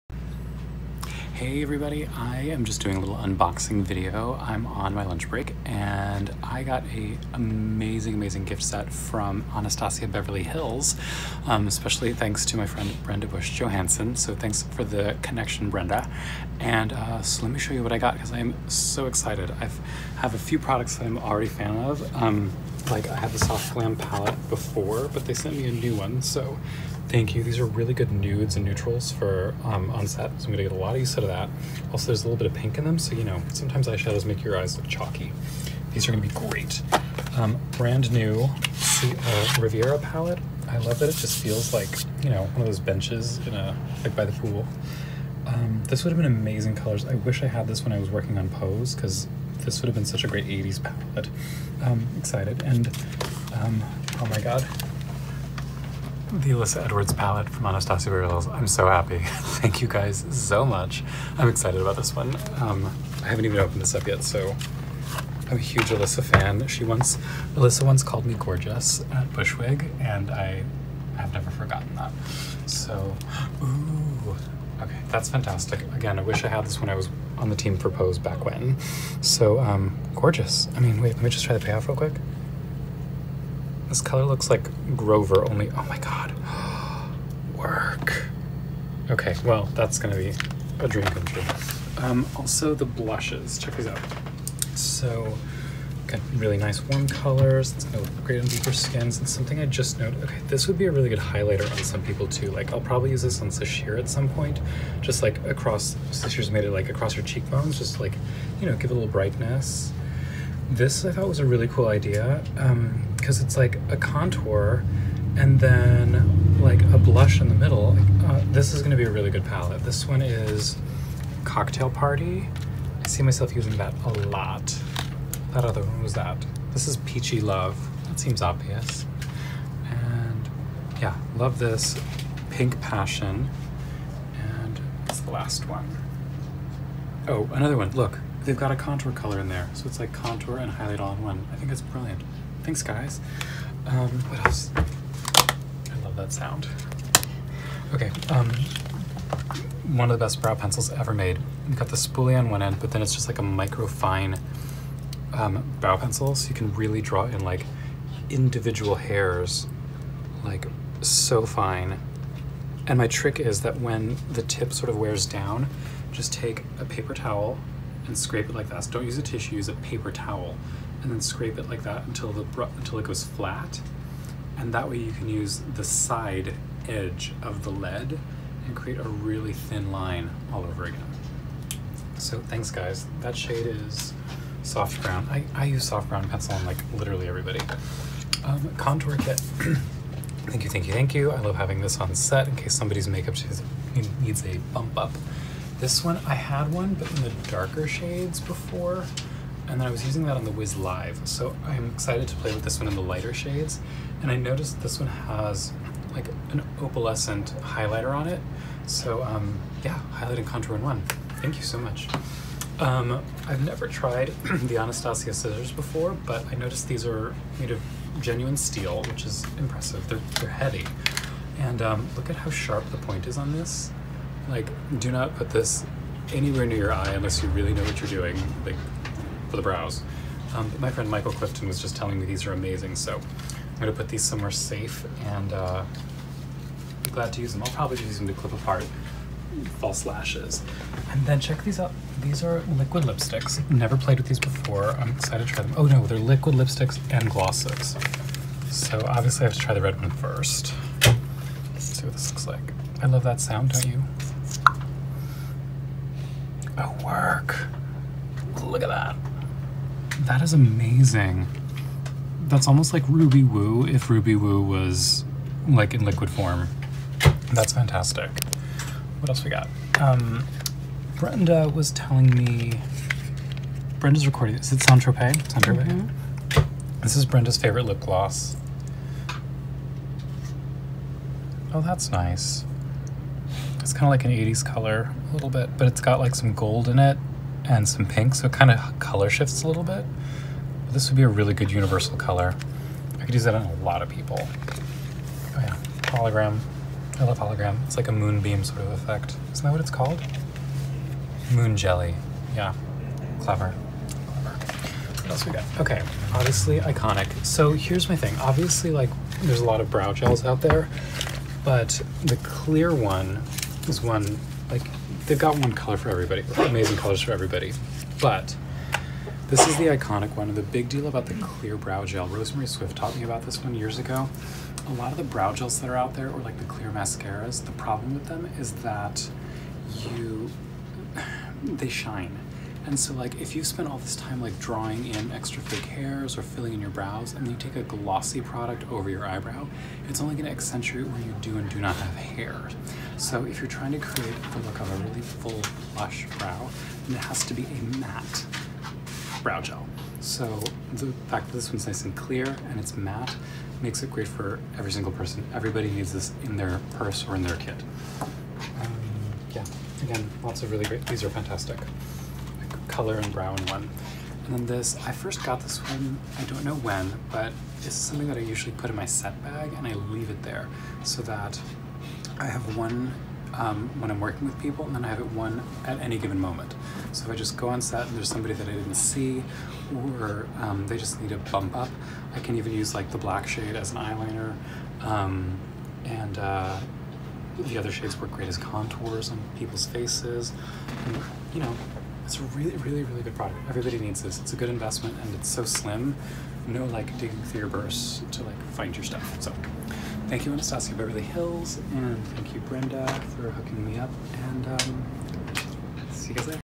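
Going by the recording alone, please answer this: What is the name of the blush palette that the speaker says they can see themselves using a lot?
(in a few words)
Cocktail Party.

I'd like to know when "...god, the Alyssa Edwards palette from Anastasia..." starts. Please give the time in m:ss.
0:54.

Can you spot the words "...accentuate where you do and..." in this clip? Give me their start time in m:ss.
5:40.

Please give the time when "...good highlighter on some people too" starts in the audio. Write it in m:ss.
1:41.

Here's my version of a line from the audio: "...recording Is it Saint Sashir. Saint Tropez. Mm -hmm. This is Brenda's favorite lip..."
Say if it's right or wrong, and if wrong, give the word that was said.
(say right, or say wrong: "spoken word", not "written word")
wrong: "Tropez", not "Sashir".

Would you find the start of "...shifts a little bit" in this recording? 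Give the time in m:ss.
4:49.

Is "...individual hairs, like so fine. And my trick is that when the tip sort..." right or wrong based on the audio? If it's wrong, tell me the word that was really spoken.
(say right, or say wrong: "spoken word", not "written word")
right.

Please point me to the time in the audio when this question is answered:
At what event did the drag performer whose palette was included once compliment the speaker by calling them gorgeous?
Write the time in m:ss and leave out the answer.
1:09.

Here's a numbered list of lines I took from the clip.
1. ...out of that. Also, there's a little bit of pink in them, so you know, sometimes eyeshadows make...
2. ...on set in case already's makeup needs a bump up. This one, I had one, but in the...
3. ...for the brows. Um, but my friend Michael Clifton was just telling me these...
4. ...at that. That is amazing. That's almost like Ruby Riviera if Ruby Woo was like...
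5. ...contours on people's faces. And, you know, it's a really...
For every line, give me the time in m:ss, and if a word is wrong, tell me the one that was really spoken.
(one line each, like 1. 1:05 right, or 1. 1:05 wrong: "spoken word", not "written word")
1. 0:31 right
2. 3:11 wrong: "somebody", not "already"
3. 3:49 right
4. 4:18 wrong: "Woo", not "Riviera"
5. 6:28 right.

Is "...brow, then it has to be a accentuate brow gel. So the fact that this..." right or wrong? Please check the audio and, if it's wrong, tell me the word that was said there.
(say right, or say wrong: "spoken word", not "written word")
wrong: "matte", not "accentuate".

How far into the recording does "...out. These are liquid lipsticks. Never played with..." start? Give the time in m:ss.
4:01.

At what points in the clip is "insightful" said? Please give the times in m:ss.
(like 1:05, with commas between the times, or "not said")
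not said.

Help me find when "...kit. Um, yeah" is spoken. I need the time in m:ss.
5:57.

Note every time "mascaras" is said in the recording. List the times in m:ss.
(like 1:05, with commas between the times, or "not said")
5:26.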